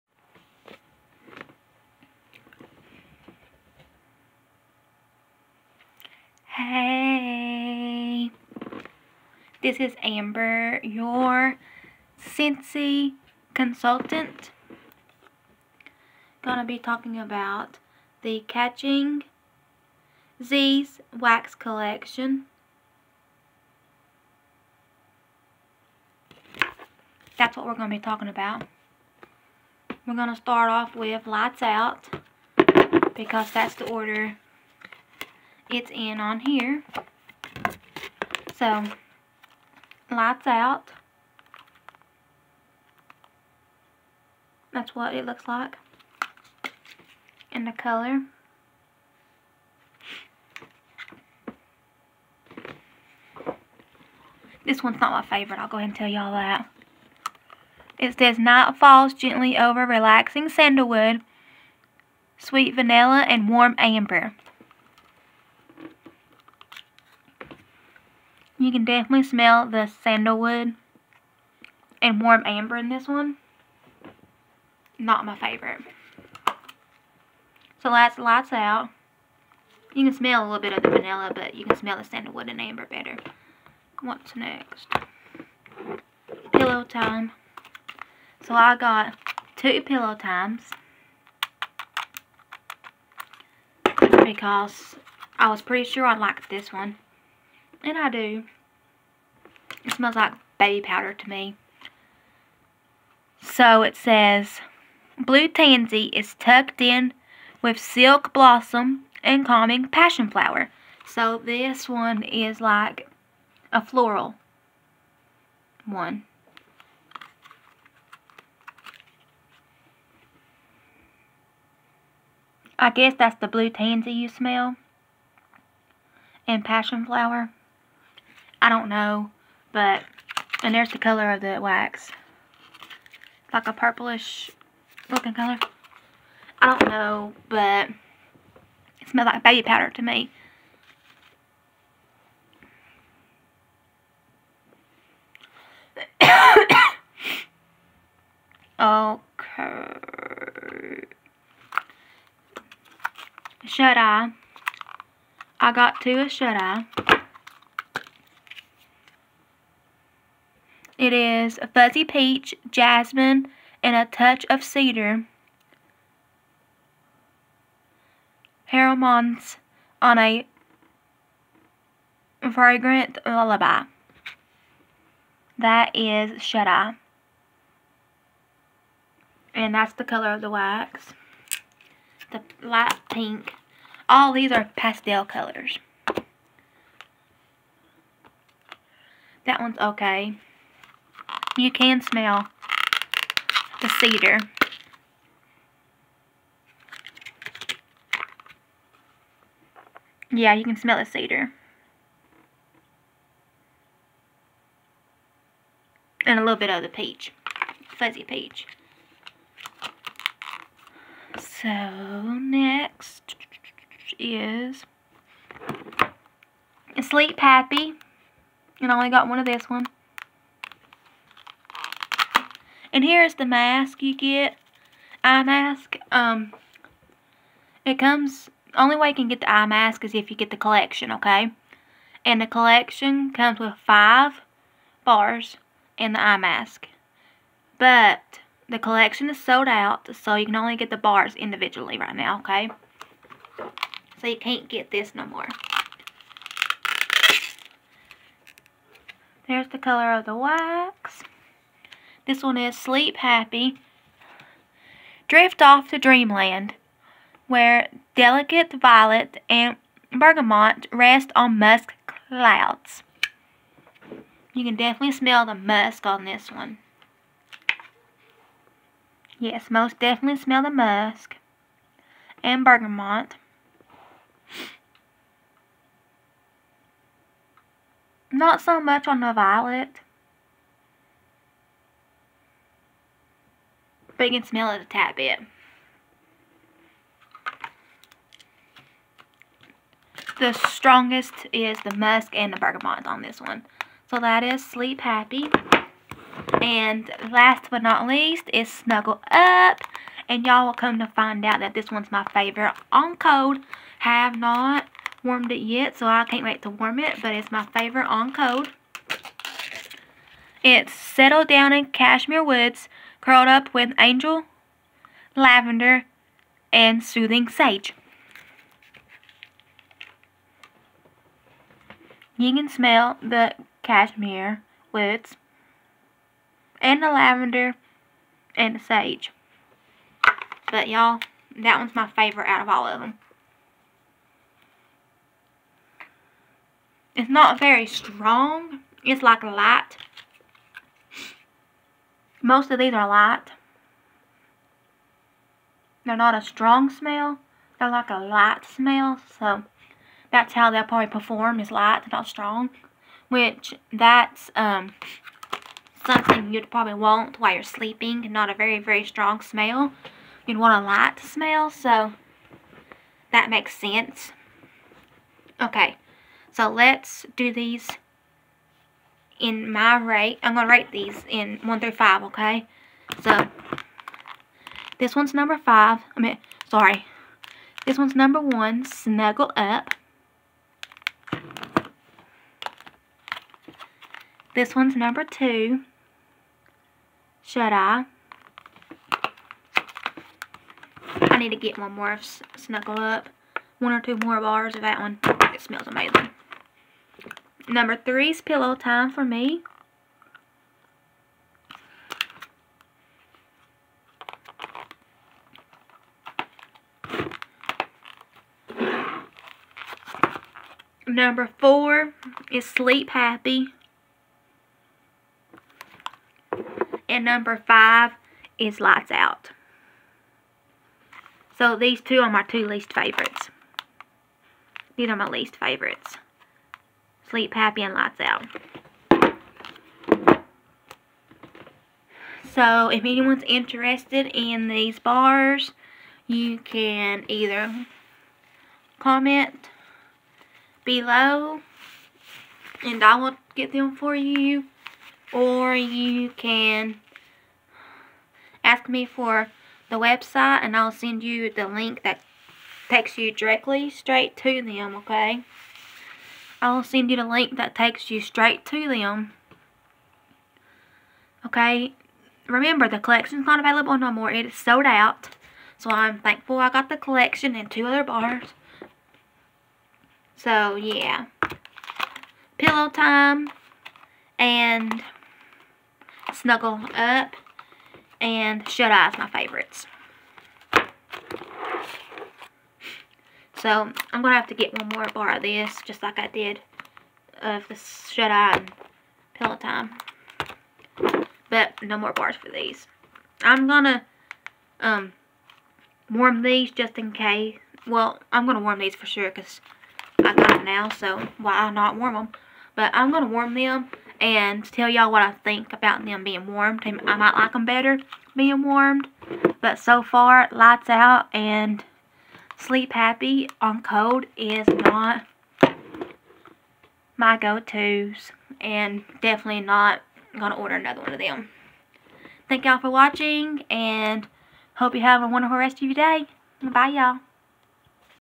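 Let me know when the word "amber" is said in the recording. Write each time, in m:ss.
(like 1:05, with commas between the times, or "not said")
0:10, 1:03, 1:12, 1:22.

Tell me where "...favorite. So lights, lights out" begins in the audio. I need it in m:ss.
1:15.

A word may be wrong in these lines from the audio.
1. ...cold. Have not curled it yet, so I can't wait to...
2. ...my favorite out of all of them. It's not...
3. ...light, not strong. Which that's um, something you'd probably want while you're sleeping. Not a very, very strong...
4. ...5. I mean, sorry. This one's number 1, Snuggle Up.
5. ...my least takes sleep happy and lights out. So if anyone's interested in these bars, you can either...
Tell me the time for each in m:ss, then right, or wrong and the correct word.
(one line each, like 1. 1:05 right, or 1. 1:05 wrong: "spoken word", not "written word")
1. 5:03 wrong: "warmed", not "curled"
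2. 5:31 right
3. 5:51 right
4. 6:15 right
5. 7:05 wrong: "favorites", not "takes".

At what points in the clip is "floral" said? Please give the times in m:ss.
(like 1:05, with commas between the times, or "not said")
1:53.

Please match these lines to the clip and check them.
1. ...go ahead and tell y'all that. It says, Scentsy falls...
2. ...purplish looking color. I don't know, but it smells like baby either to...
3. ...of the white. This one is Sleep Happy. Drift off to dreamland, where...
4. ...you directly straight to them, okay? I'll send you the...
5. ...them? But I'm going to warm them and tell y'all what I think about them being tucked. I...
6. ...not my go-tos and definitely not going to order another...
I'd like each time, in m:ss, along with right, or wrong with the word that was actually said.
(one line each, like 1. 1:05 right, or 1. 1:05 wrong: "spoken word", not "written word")
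1. 0:55 wrong: "Night", not "Scentsy"
2. 2:13 wrong: "powder", not "either"
3. 4:10 right
4. 7:33 right
5. 8:22 wrong: "warmed", not "tucked"
6. 8:34 right.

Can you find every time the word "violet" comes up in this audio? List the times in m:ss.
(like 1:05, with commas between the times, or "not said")
4:18, 4:39.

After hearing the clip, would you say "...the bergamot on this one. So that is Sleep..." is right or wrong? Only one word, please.
right.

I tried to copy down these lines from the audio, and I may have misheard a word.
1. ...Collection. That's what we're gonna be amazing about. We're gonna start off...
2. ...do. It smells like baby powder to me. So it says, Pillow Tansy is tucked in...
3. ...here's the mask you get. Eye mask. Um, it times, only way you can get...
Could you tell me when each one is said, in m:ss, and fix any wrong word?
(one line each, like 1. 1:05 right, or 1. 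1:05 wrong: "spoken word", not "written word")
1. 0:21 wrong: "talking", not "amazing"
2. 1:38 wrong: "Blue", not "Pillow"
3. 3:43 wrong: "comes", not "times".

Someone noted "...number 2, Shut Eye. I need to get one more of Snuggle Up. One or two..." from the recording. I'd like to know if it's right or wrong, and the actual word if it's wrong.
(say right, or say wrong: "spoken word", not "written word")
right.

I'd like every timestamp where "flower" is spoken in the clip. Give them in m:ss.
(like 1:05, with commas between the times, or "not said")
1:50, 2:07.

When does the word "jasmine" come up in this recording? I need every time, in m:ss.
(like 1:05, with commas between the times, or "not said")
2:42.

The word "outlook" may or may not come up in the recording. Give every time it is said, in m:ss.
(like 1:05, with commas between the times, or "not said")
not said.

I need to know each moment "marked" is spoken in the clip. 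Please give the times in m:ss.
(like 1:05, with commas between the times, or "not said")
not said.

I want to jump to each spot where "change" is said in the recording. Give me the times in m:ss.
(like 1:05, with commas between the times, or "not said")
not said.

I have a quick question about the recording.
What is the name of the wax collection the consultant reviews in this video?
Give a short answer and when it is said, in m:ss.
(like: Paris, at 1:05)
Catching Z's, at 0:18.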